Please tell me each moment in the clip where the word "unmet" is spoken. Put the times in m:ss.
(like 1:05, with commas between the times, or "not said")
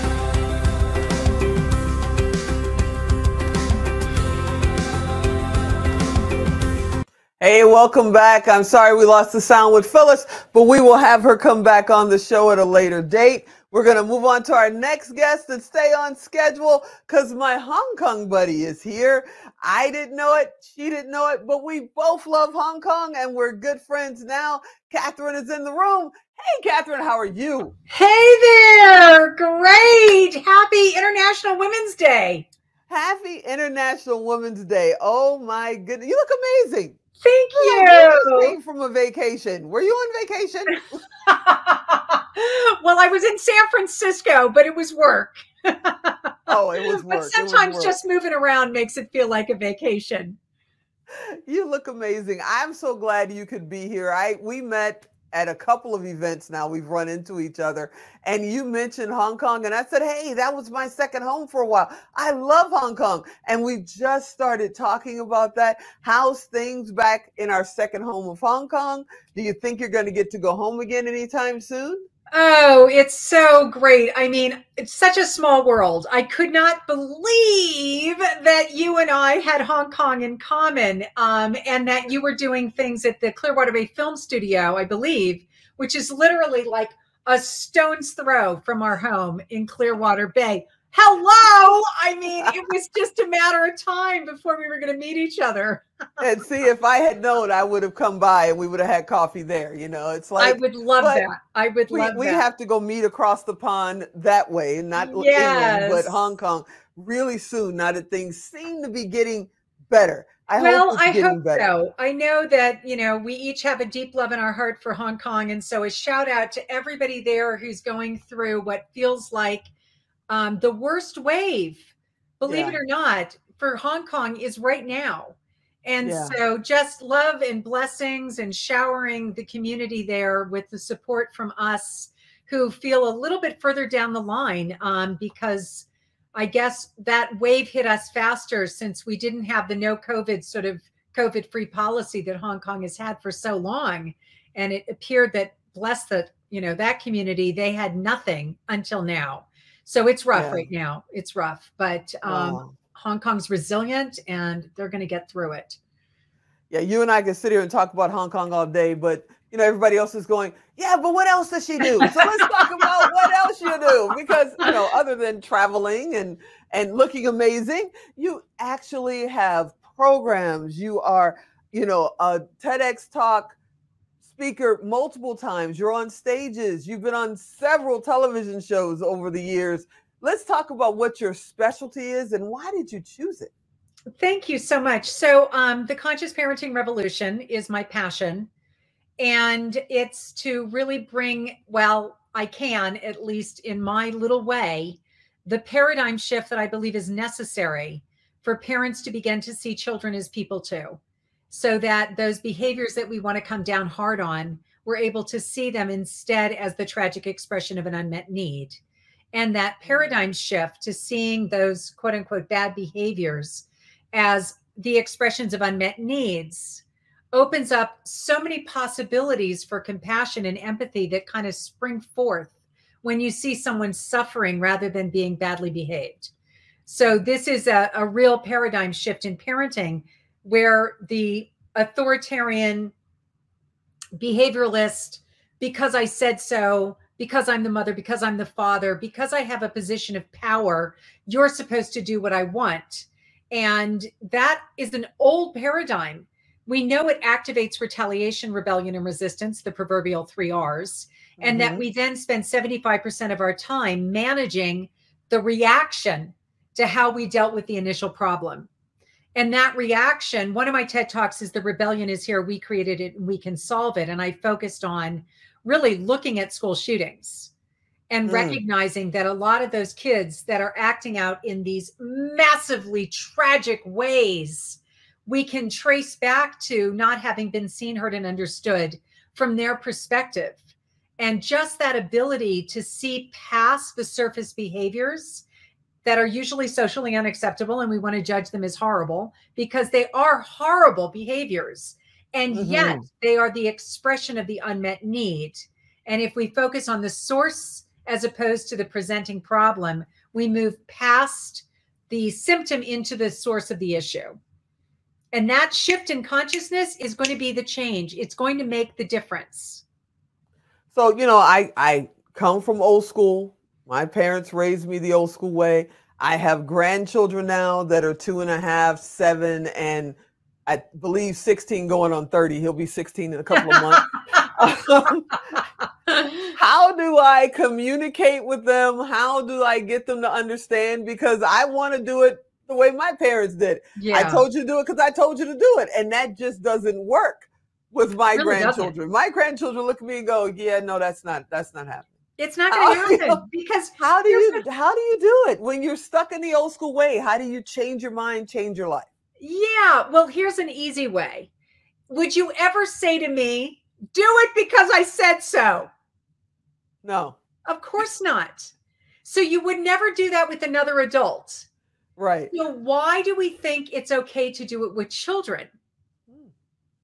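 3:27, 3:35, 4:54.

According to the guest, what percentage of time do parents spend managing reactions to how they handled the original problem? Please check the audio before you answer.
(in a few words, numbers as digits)
75%.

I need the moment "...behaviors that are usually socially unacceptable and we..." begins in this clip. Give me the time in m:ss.
4:44.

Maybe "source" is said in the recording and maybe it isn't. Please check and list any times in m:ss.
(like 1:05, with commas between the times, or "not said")
4:57, 5:03.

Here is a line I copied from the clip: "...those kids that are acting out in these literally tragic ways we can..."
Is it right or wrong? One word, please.
wrong.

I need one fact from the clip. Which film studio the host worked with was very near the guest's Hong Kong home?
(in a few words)
Clearwater Bay Film Studio.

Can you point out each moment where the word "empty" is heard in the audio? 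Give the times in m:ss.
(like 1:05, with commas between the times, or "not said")
not said.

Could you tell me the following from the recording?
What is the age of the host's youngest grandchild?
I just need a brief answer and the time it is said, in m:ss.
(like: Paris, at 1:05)
2 and a half, at 5:18.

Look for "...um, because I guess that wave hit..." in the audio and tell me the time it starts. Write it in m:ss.
2:14.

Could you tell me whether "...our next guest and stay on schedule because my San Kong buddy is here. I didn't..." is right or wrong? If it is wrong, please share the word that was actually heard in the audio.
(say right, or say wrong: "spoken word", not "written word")
wrong: "Hong", not "San".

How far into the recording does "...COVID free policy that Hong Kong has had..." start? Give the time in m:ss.
2:21.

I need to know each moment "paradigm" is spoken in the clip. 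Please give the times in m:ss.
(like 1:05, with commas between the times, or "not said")
3:15, 3:29, 3:48, 4:05.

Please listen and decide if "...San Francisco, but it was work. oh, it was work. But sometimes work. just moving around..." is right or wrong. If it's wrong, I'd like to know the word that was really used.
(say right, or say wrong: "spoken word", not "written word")
right.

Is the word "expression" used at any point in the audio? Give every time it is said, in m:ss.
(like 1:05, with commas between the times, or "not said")
3:27, 3:34, 4:53.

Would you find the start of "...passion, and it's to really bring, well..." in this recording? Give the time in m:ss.
3:07.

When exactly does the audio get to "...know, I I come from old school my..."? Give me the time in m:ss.
5:11.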